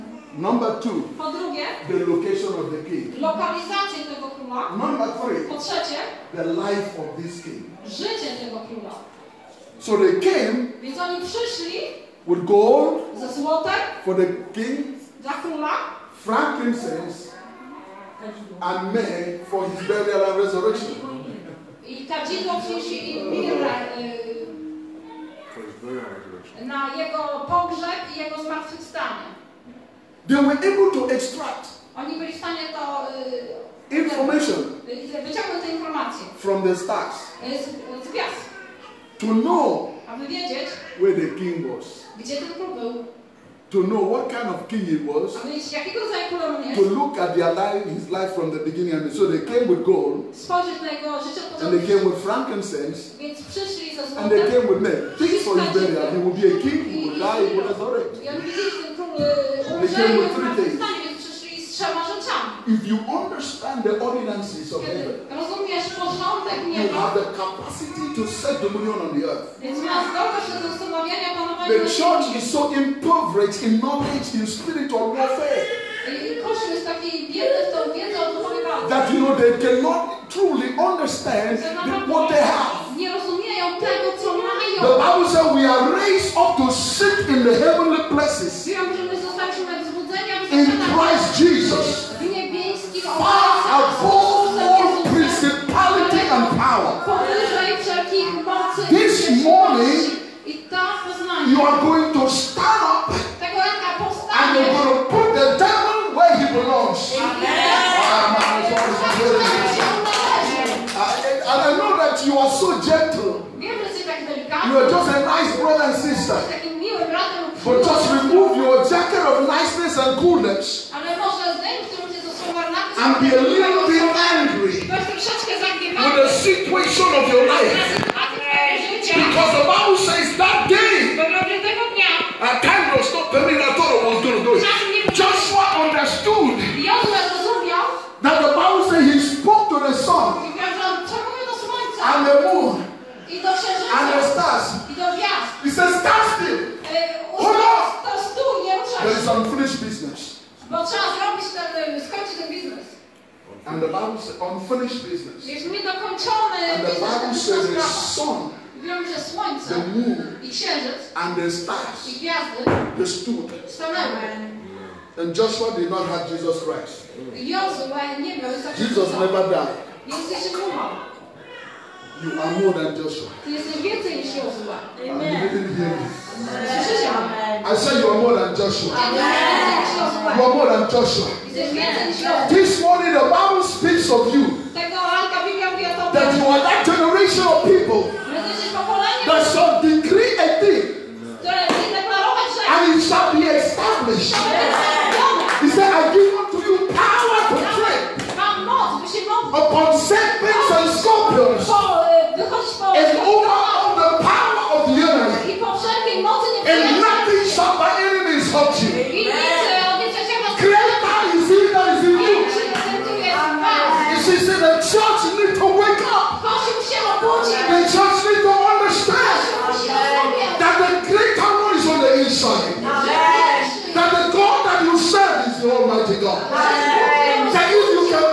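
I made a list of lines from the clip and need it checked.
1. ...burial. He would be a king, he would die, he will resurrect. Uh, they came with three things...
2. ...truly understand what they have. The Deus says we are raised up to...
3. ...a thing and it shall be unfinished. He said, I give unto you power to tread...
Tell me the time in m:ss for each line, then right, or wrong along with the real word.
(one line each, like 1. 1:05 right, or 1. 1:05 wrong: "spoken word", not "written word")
1. 0:55 right
2. 1:20 wrong: "Bible", not "Deus"
3. 3:10 wrong: "established", not "unfinished".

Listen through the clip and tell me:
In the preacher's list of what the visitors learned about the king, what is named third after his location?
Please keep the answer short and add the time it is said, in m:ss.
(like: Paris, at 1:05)
The life of this king, at 0:06.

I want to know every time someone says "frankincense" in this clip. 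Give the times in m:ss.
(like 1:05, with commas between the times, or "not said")
0:16, 0:52.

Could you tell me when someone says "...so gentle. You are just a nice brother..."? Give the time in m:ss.
1:52.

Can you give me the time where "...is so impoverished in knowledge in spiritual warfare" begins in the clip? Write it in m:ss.
1:12.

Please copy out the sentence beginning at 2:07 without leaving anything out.
Because the Bible says that day, a time was not permitted, I I was going to do it.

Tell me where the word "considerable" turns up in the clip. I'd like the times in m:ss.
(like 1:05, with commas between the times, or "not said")
not said.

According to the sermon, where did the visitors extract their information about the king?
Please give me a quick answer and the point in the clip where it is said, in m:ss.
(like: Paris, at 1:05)
From the stars, at 0:36.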